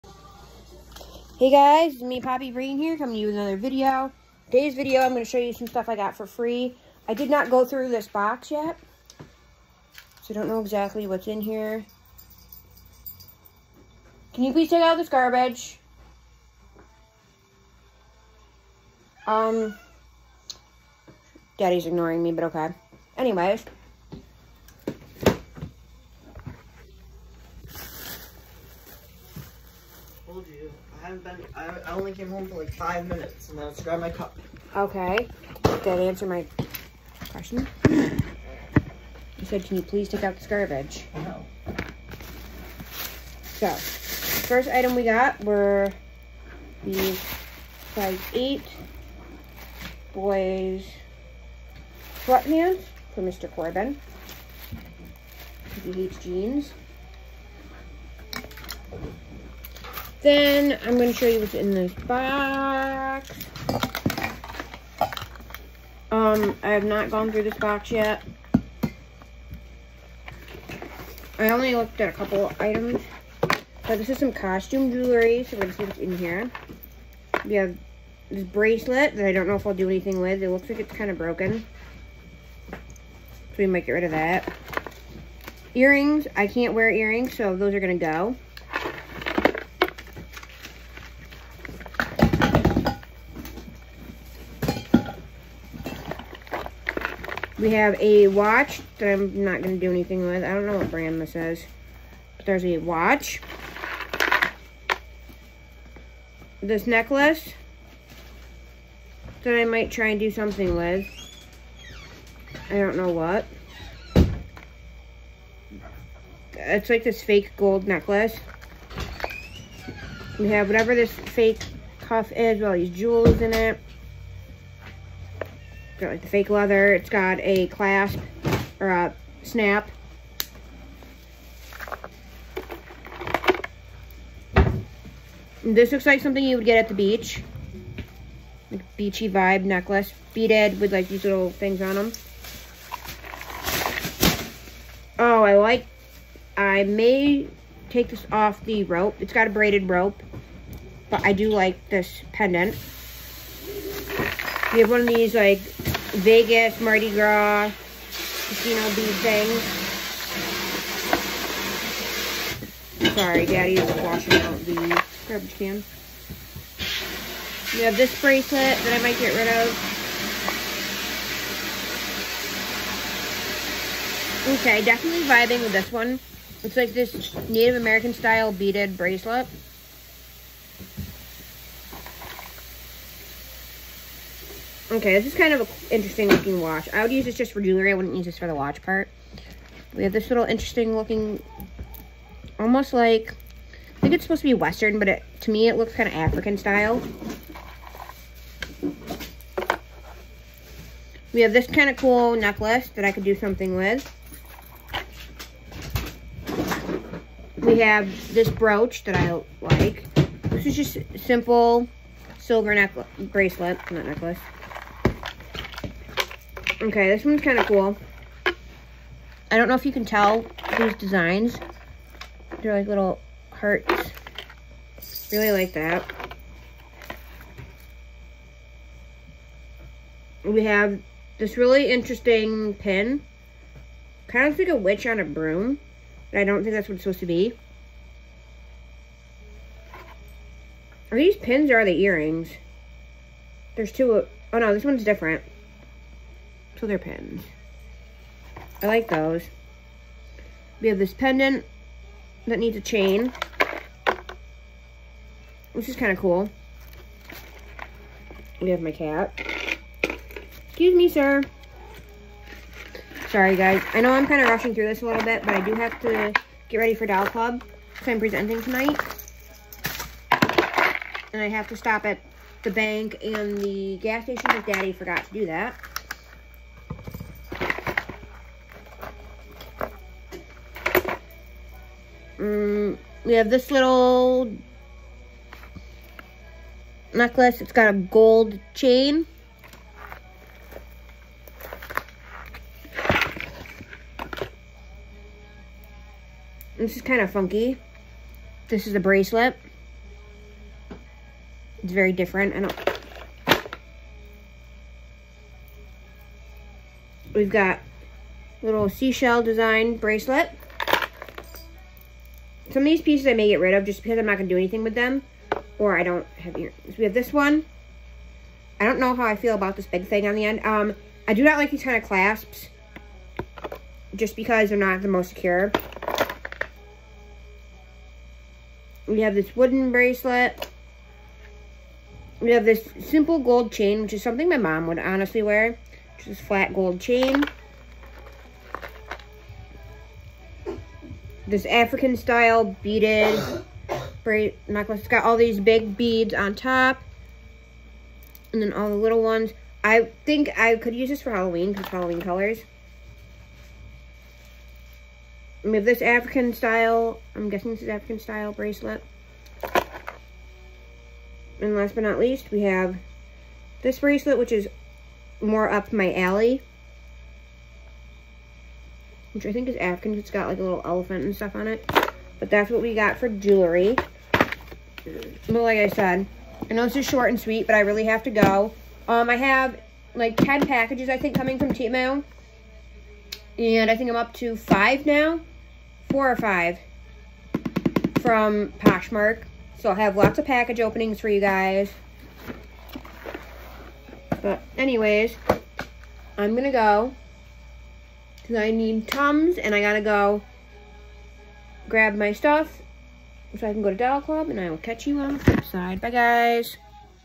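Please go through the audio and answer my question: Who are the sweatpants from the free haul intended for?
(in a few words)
Mr. Corbin.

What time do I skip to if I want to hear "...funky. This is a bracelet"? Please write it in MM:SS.
04:57.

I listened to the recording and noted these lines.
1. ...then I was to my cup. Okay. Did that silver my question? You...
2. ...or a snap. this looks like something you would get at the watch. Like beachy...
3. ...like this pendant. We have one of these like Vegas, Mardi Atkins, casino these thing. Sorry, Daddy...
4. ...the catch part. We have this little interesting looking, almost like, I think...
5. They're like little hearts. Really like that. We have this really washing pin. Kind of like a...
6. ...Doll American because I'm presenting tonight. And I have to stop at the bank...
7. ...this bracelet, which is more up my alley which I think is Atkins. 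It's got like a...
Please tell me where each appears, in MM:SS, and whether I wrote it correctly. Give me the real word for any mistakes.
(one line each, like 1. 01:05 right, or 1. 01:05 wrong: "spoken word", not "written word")
1. 00:33 wrong: "answer", not "silver"
2. 02:08 wrong: "beach", not "watch"
3. 02:31 wrong: "Gras", not "Atkins"
4. 03:08 wrong: "watch", not "catch"
5. 03:42 wrong: "interesting", not "washing"
6. 04:27 wrong: "Club", not "American"
7. 06:03 right.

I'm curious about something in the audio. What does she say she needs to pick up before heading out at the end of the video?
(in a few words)
Tums.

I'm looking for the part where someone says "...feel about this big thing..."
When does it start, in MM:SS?
05:19.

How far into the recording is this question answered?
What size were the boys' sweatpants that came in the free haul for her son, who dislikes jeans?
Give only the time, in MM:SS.
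00:47.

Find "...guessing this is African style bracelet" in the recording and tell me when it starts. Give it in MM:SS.
05:57.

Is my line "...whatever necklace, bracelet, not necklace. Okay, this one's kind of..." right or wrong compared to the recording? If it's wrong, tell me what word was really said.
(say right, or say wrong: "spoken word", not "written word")
wrong: "silver", not "whatever".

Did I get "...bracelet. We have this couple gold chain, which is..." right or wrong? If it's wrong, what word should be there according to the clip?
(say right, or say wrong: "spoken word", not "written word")
wrong: "simple", not "couple".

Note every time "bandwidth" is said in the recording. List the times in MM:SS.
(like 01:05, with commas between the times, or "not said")
not said.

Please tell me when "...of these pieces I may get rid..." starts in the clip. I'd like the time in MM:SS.
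05:12.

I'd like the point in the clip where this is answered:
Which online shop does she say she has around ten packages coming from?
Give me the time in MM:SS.
06:21.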